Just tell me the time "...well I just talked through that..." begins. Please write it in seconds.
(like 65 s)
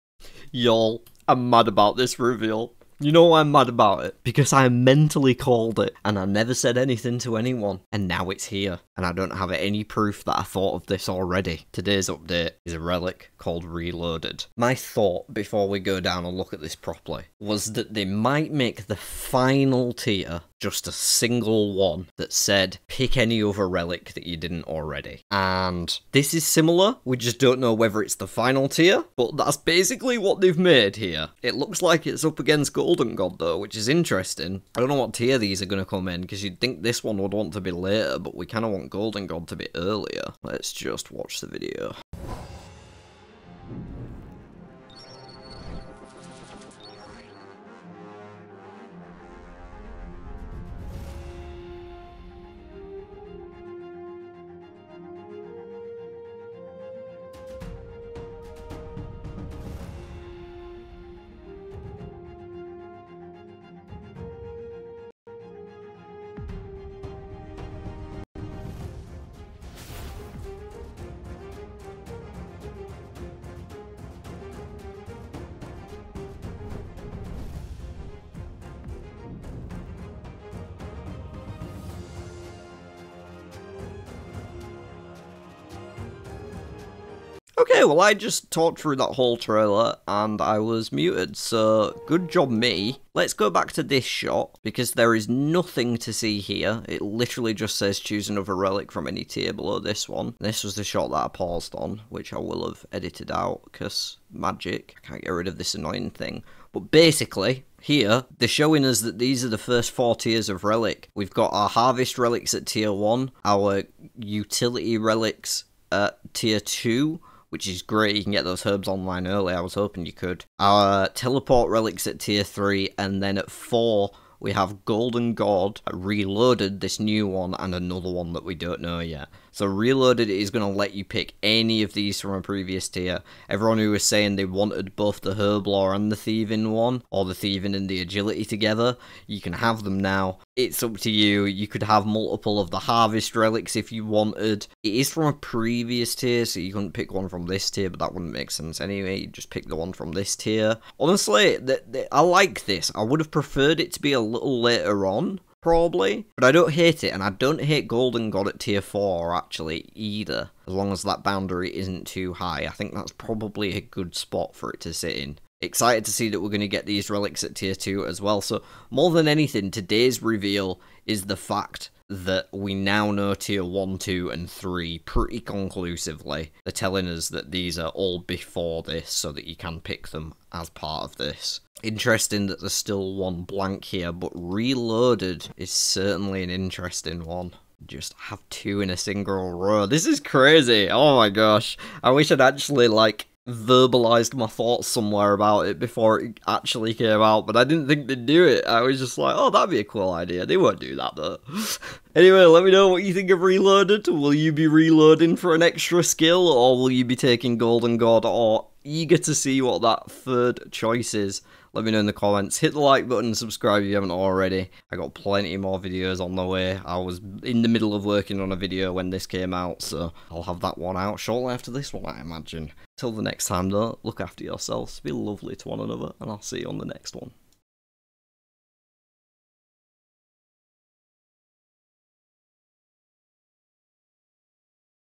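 87 s.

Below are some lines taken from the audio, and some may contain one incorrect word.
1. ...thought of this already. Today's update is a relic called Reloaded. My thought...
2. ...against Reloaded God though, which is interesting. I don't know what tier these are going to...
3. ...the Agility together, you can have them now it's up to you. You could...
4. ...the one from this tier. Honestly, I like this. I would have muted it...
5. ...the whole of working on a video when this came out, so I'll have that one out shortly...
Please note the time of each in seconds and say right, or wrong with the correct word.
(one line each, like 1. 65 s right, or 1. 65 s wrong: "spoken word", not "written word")
1. 10 s right
2. 32 s wrong: "Golden", not "Reloaded"
3. 137 s right
4. 149 s wrong: "preferred", not "muted"
5. 217 s wrong: "middle", not "whole".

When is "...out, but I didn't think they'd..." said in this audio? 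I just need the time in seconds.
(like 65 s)
197 s.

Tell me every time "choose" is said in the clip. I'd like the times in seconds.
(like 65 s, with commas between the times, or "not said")
97 s.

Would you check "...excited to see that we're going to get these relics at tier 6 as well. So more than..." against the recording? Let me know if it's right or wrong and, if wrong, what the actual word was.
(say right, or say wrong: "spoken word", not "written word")
wrong: "2", not "6".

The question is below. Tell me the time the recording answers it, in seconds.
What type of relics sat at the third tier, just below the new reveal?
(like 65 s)
121 s.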